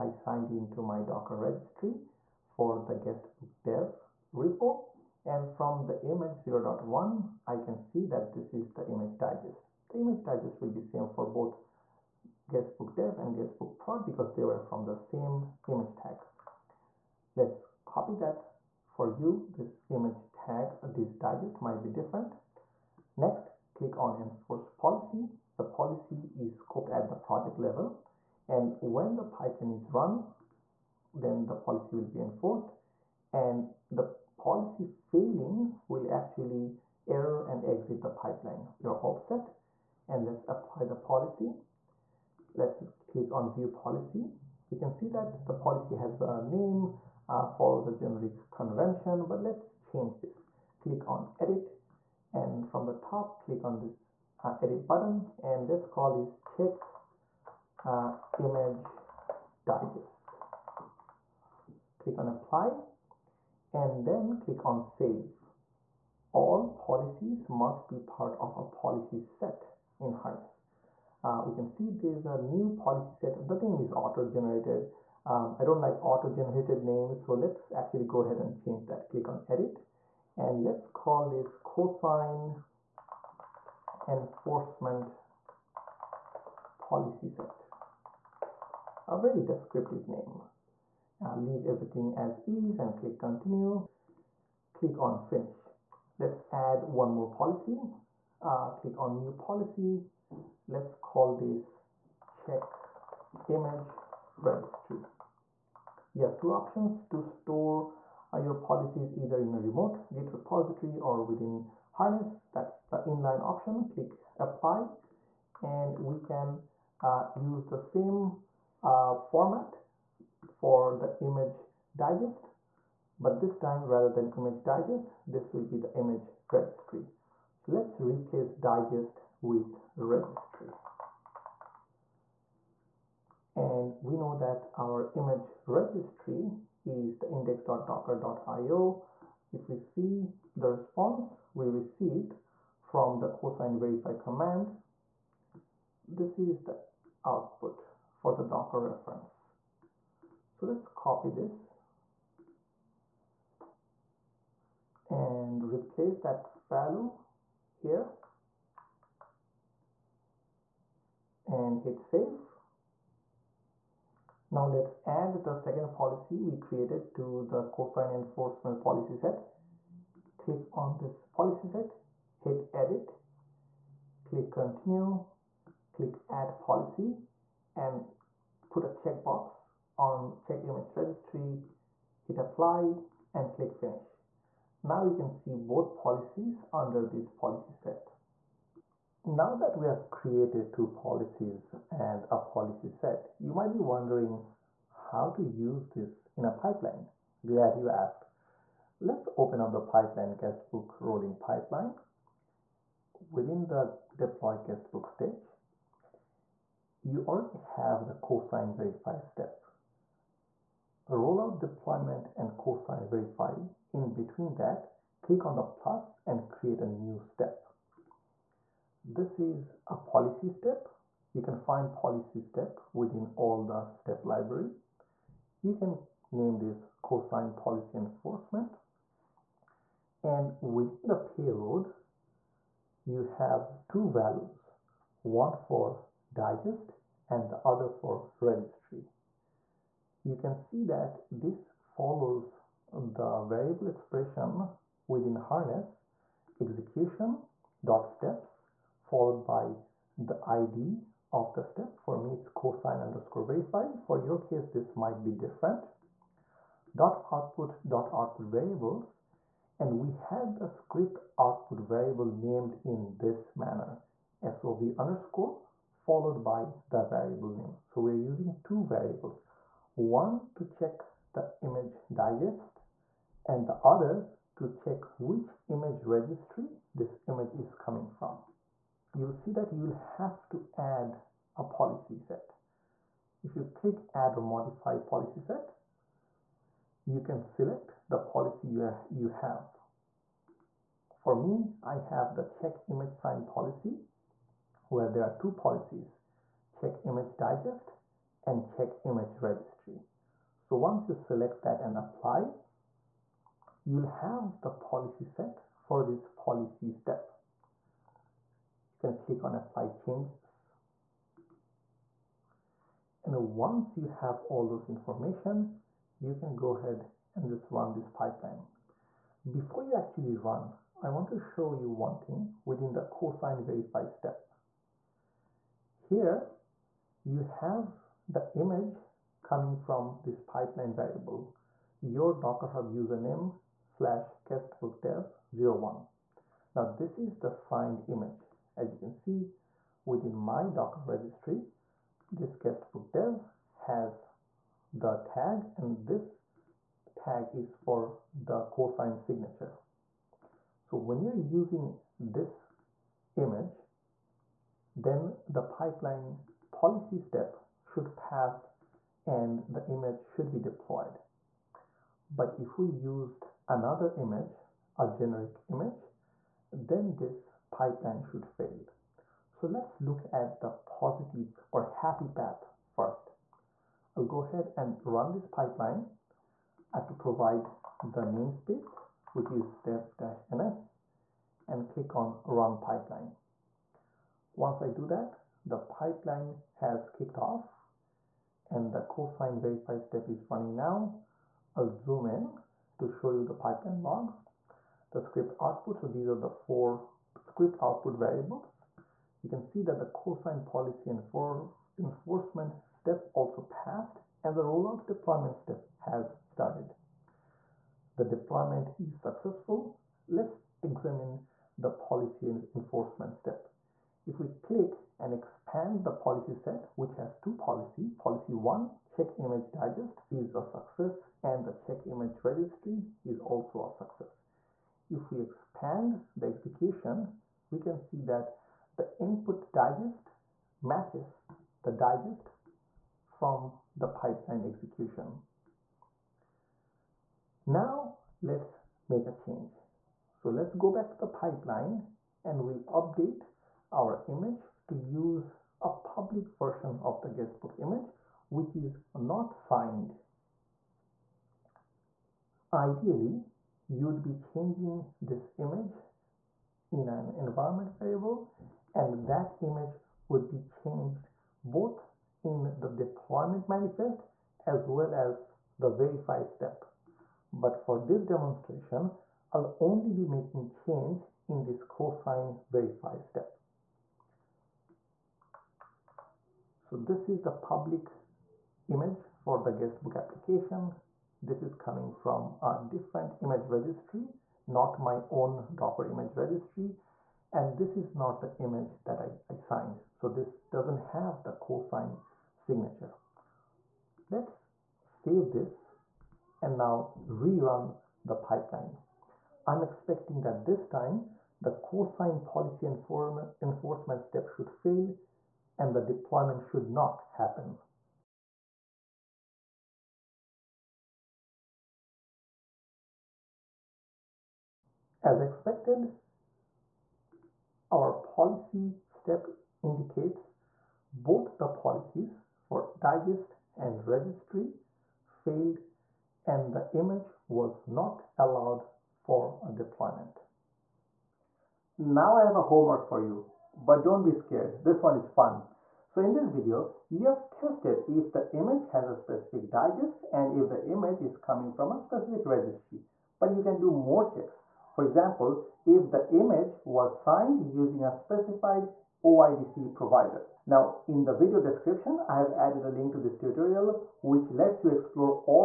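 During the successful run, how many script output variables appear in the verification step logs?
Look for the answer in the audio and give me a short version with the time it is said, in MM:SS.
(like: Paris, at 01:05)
4, at 06:36.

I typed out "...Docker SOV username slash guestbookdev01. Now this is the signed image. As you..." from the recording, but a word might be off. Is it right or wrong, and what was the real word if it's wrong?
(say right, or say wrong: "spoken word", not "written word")
wrong: "Hub", not "SOV".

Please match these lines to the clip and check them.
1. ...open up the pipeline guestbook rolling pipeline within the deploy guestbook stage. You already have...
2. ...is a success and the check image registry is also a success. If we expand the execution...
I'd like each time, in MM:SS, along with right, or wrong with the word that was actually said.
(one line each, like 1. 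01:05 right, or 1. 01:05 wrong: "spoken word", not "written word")
1. 03:19 right
2. 07:00 right.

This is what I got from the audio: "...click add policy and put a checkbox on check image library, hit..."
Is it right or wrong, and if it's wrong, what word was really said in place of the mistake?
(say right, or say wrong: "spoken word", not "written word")
wrong: "registry", not "library".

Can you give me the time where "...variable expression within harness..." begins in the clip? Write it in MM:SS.
04:03.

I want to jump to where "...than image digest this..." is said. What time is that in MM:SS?
02:04.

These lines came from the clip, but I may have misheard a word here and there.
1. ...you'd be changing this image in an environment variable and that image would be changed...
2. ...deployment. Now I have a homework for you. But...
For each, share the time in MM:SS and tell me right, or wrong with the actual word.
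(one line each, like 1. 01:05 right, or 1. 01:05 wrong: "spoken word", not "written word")
1. 07:33 right
2. 08:49 right.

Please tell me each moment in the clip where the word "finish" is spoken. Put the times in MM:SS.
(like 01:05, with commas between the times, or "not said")
01:35, 03:03.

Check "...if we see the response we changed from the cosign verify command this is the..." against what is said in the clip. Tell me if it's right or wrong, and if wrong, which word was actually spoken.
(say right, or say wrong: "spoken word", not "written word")
wrong: "received", not "changed".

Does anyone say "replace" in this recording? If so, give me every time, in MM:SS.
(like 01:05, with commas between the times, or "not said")
02:08, 02:35.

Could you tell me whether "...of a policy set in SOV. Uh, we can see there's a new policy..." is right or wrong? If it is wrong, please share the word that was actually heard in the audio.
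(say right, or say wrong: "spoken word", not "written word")
wrong: "Harness", not "SOV".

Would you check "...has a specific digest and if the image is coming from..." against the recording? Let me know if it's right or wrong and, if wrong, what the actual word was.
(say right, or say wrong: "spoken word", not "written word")
right.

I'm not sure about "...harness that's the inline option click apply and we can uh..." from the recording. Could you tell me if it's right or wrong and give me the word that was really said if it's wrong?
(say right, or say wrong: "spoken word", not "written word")
right.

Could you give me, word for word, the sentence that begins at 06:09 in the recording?
So let's look at the positive or happy path first.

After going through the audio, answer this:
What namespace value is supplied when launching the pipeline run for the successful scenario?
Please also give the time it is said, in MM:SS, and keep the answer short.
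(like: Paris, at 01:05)
dev-ns, at 06:19.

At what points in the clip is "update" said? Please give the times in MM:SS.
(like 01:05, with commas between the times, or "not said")
07:22.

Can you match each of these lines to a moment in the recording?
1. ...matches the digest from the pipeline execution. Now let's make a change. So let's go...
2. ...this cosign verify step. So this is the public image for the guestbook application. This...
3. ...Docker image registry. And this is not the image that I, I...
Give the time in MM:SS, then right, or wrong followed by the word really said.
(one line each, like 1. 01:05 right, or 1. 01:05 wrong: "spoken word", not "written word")
1. 07:10 right
2. 07:51 right
3. 08:05 right.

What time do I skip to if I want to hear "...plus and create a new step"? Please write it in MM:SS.
03:35.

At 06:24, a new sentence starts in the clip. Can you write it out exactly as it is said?
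Once I do that, the pipeline has kicked off and the cosign verify step is running now.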